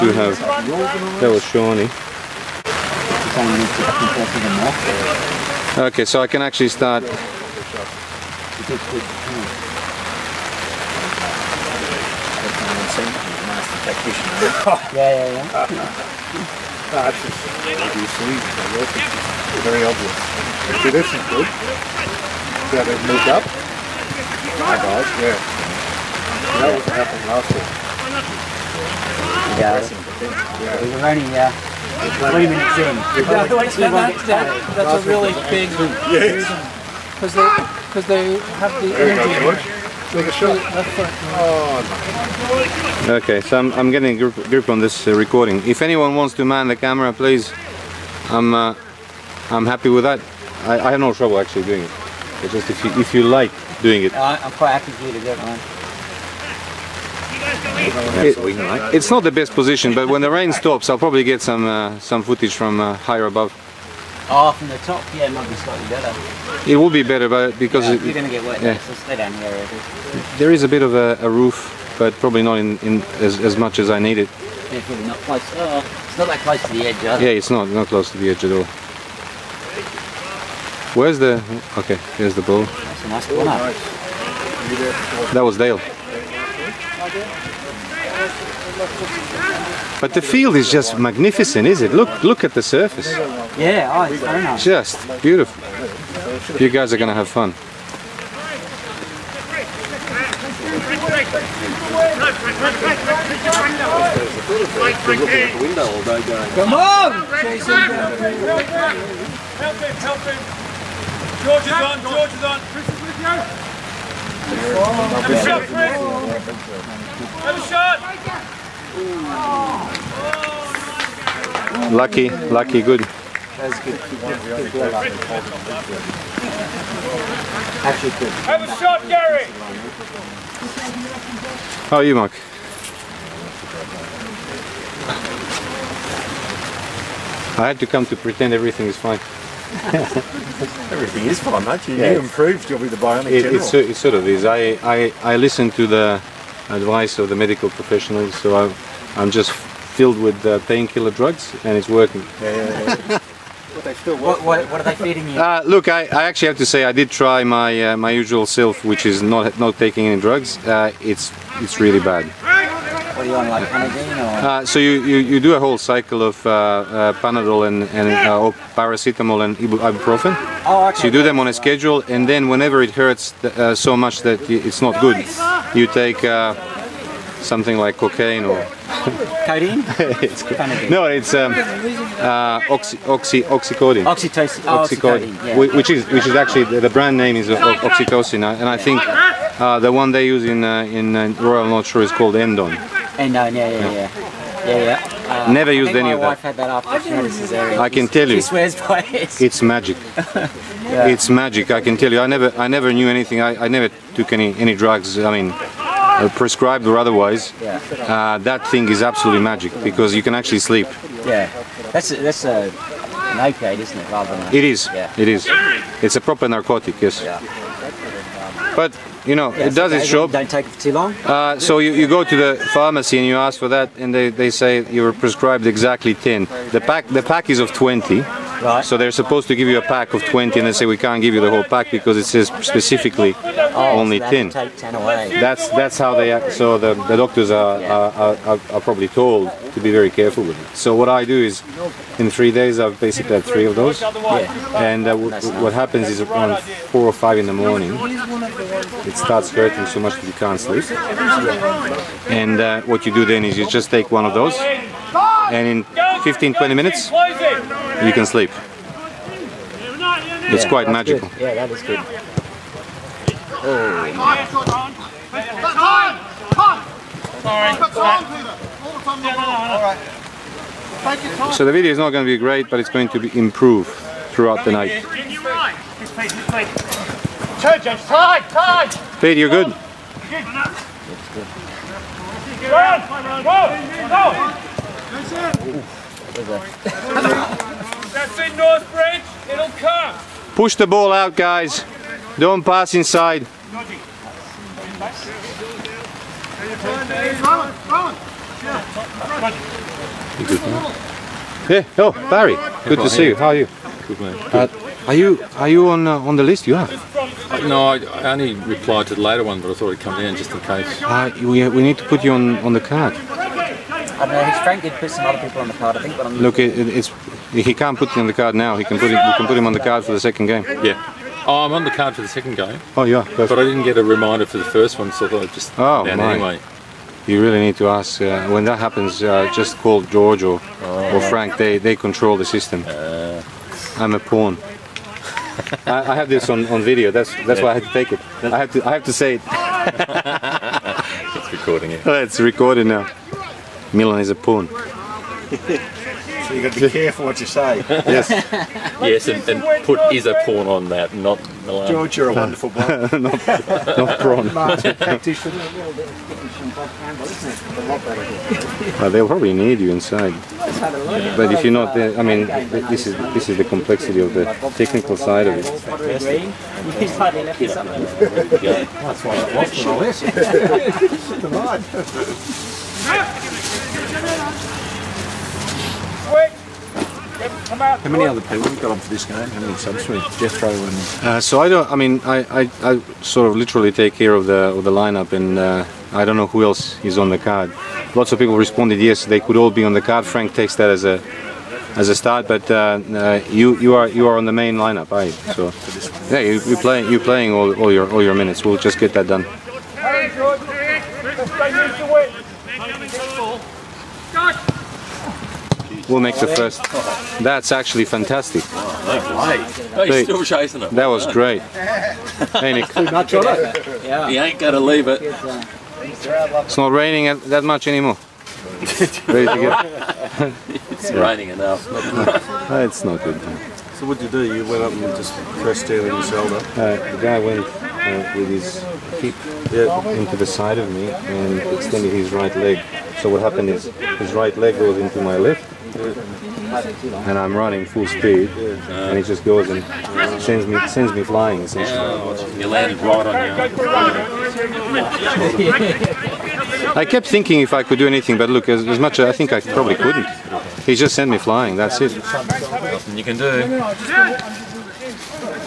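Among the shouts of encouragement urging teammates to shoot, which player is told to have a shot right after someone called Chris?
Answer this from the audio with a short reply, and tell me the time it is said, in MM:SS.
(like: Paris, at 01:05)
Gary, at 02:09.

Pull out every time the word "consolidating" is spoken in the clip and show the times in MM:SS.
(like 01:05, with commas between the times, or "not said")
not said.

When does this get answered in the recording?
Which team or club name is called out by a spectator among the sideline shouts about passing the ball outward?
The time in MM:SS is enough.
04:48.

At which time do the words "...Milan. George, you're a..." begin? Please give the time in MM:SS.
05:51.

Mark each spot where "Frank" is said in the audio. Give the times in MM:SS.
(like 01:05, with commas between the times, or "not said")
05:31, 06:30.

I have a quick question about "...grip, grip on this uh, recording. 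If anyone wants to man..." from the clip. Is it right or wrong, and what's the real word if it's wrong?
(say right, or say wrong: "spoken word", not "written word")
right.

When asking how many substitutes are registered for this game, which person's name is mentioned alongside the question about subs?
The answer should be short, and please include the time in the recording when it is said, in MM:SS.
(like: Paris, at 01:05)
Jethro, at 06:20.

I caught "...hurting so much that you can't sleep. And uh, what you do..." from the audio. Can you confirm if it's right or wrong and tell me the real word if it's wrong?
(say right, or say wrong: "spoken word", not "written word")
right.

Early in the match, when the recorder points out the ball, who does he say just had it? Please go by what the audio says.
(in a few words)
Dale.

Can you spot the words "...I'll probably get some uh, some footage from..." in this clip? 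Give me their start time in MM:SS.
01:00.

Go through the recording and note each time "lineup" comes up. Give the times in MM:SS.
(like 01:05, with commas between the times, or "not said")
06:24, 06:34.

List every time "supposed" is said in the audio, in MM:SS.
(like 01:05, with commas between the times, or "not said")
03:49.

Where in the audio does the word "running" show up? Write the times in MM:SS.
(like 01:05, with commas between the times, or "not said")
00:31, 07:17.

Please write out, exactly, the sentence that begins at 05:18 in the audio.
He can put him, you can put him on the card for the second game.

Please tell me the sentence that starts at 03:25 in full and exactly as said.
I mean, uh, prescribed or otherwise, yeah.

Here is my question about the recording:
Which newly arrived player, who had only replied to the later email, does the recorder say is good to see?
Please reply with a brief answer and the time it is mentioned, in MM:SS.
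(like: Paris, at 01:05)
Barry, at 05:02.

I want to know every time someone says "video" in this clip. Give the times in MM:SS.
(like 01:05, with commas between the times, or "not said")
04:31, 05:36.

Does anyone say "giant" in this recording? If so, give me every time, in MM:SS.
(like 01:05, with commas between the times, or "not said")
not said.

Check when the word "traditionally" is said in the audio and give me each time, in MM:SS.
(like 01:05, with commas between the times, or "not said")
not said.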